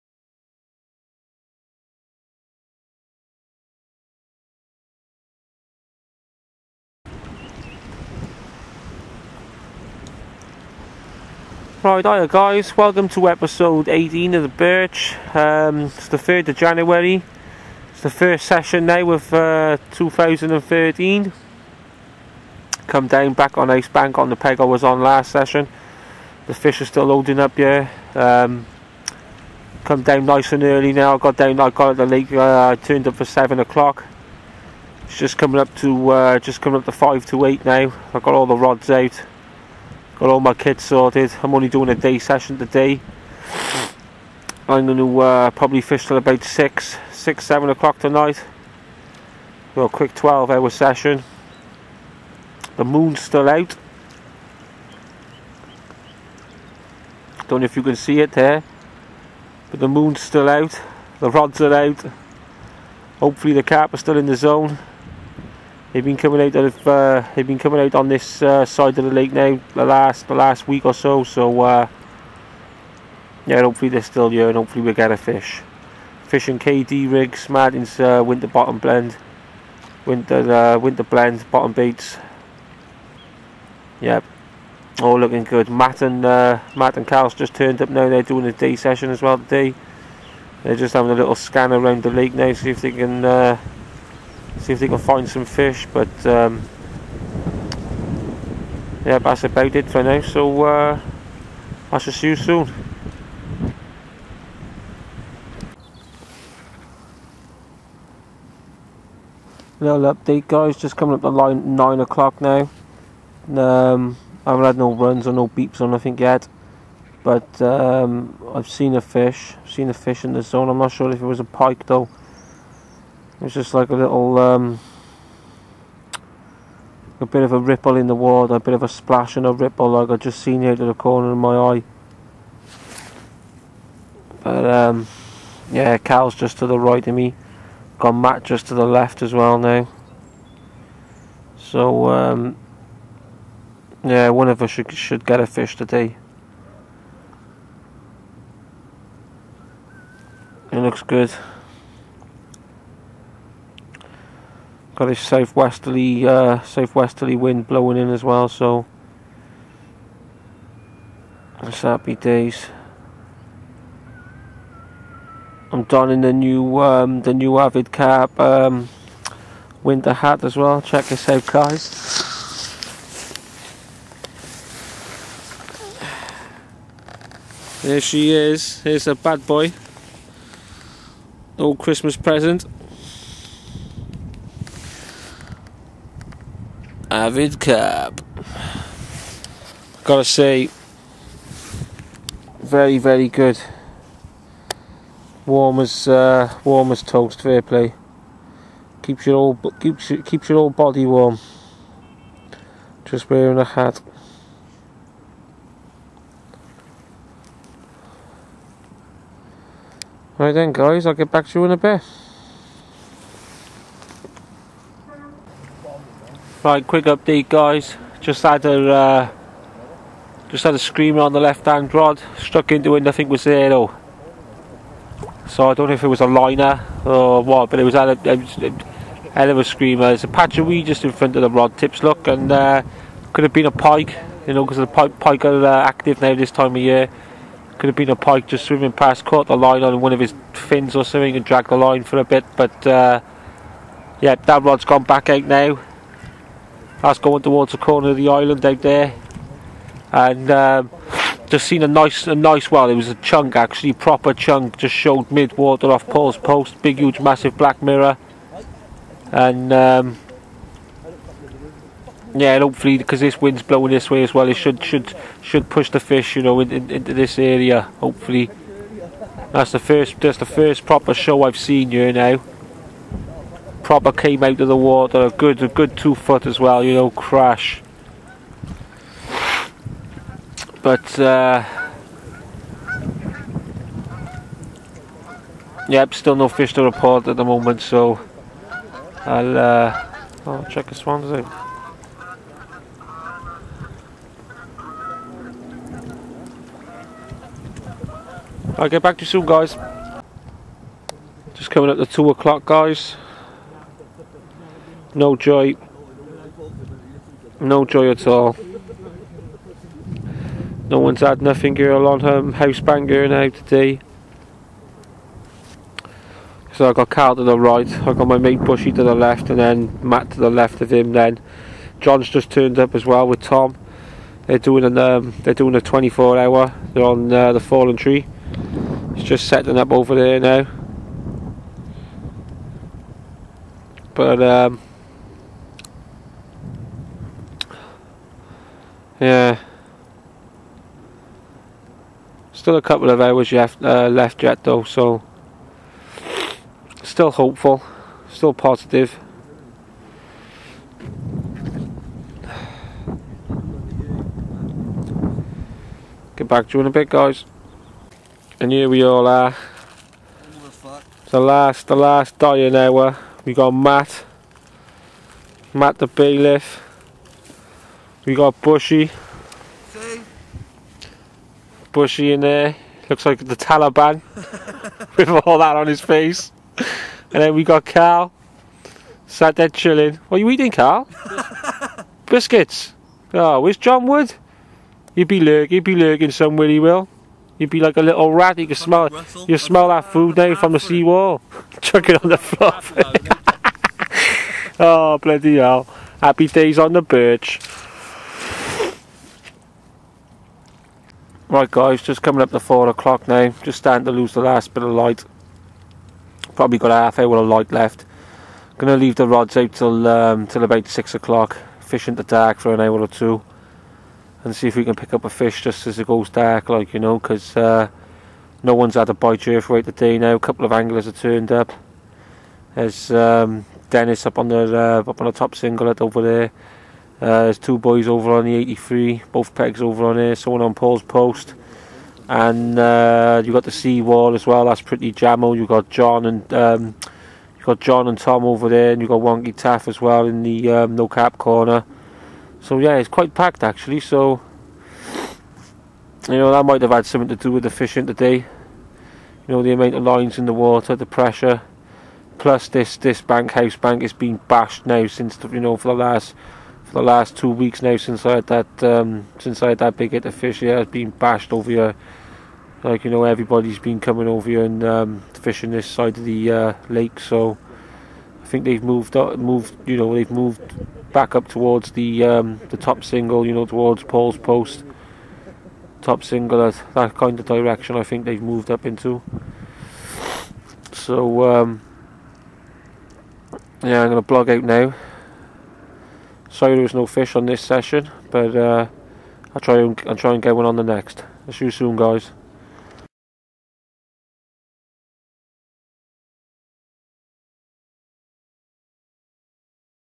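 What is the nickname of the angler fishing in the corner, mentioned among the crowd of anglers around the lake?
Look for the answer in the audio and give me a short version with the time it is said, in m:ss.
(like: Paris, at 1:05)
Wonky Taff, at 7:19.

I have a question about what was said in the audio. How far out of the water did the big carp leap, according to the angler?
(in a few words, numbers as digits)
2 foot.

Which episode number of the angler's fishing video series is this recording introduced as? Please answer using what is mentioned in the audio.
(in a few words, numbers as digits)
18.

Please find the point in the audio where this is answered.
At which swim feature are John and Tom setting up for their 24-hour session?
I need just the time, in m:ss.
5:27.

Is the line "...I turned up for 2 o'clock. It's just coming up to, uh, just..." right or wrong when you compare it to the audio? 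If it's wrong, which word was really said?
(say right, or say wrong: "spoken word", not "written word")
wrong: "7", not "2".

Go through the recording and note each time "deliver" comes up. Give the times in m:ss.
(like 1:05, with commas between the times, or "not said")
not said.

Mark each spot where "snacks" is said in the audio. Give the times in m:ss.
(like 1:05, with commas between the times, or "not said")
not said.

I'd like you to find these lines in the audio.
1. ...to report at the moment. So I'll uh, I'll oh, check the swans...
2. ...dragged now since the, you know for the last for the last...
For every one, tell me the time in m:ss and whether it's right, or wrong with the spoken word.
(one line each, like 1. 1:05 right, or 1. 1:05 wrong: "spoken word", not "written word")
1. 4:46 right
2. 7:34 wrong: "bashed", not "dragged".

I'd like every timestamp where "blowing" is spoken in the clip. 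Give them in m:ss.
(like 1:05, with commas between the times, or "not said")
2:37, 4:23.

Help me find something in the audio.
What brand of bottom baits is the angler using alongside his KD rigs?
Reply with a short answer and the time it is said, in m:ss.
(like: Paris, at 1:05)
Martin's, at 1:17.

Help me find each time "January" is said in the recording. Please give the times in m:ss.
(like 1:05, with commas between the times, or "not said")
0:16.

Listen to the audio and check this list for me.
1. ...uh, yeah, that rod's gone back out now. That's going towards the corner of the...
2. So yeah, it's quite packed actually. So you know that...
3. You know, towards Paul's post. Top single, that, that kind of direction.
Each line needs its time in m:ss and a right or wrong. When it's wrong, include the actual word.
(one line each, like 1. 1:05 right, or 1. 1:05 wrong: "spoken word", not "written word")
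1. 4:02 right
2. 7:22 right
3. 7:53 right.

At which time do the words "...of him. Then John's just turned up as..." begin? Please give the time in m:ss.
5:20.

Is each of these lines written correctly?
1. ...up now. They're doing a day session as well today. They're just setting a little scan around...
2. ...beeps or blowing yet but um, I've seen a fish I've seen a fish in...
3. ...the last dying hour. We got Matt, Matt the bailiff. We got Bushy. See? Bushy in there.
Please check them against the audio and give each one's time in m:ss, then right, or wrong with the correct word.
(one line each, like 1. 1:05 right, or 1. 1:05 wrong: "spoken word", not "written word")
1. 1:27 wrong: "having", not "setting"
2. 1:55 wrong: "nothing", not "blowing"
3. 6:01 right.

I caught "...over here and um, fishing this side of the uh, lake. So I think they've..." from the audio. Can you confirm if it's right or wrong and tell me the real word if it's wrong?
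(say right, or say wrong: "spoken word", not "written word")
right.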